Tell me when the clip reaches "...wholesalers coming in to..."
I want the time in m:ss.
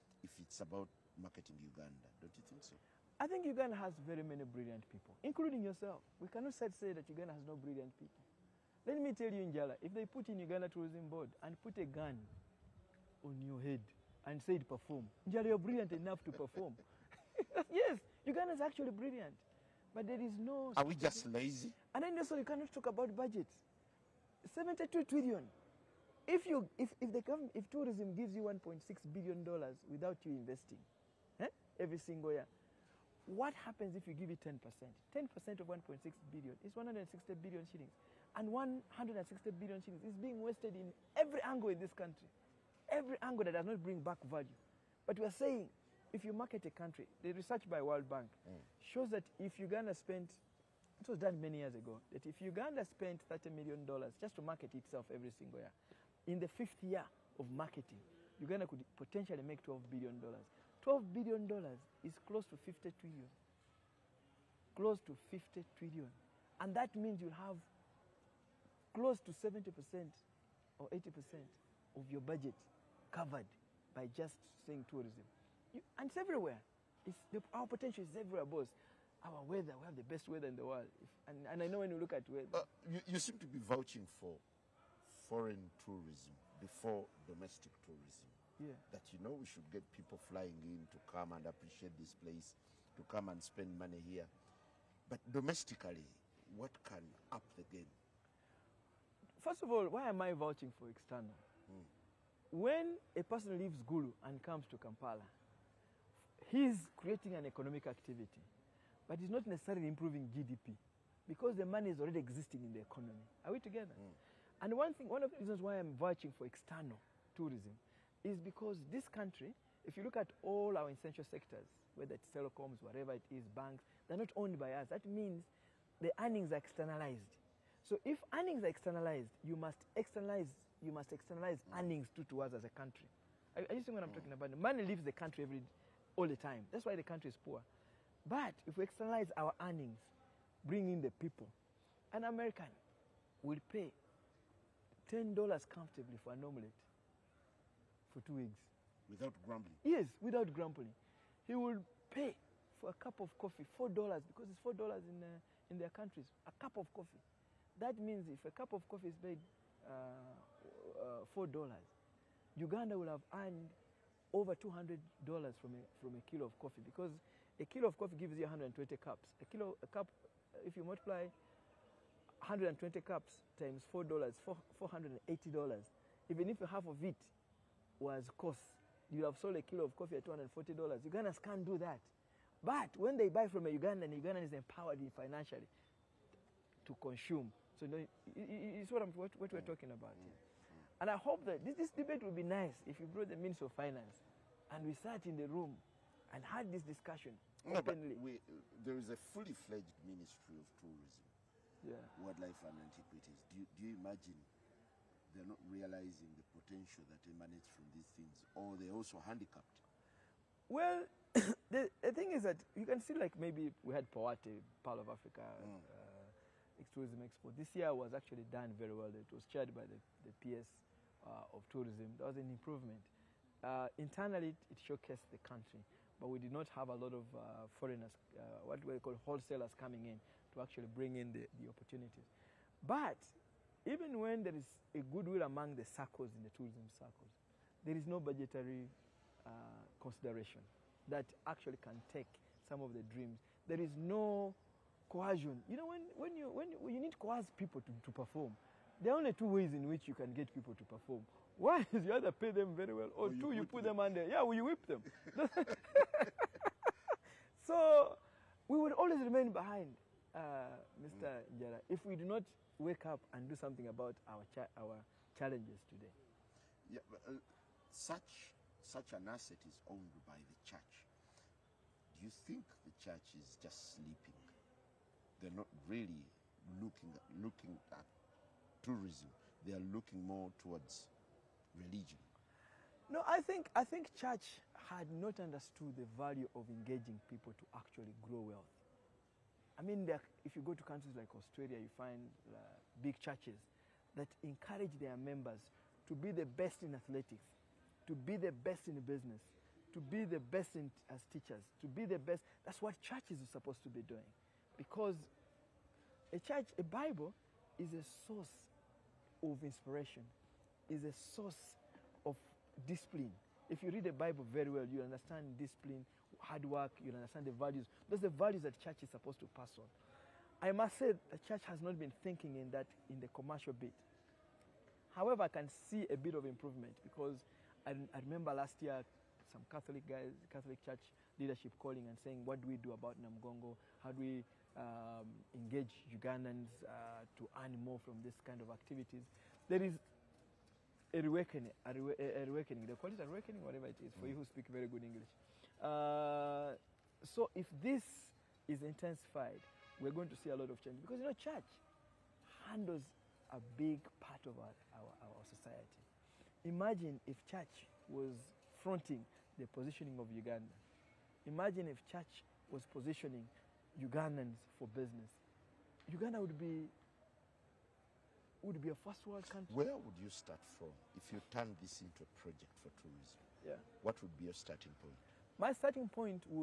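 3:49.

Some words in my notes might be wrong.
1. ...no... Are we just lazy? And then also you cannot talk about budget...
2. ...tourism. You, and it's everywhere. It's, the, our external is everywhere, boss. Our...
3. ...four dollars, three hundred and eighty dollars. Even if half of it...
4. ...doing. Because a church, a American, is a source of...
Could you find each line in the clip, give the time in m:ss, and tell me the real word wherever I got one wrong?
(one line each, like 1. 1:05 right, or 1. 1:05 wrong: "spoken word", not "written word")
1. 0:20 right
2. 1:14 wrong: "potential", not "external"
3. 2:53 wrong: "four", not "three"
4. 5:04 wrong: "Bible", not "American".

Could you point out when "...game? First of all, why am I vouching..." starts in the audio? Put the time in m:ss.
1:37.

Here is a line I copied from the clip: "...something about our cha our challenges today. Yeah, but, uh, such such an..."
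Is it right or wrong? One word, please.
right.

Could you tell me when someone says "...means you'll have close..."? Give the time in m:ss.
1:06.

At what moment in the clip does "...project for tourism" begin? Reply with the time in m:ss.
6:12.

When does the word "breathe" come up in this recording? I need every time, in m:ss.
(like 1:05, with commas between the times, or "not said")
not said.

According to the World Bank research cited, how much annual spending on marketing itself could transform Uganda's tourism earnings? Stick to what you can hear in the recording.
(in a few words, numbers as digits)
$30 million.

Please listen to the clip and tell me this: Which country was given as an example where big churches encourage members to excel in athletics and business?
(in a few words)
Australia.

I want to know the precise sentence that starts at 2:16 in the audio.
That's why the country is poor.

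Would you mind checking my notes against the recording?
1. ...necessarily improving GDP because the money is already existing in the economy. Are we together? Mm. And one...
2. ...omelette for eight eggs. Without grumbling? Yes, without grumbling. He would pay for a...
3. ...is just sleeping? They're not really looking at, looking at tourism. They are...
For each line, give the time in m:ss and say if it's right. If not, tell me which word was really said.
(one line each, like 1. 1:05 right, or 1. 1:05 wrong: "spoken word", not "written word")
1. 1:49 right
2. 2:26 wrong: "two", not "eight"
3. 4:33 right.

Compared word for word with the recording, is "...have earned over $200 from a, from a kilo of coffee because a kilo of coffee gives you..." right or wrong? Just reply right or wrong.
right.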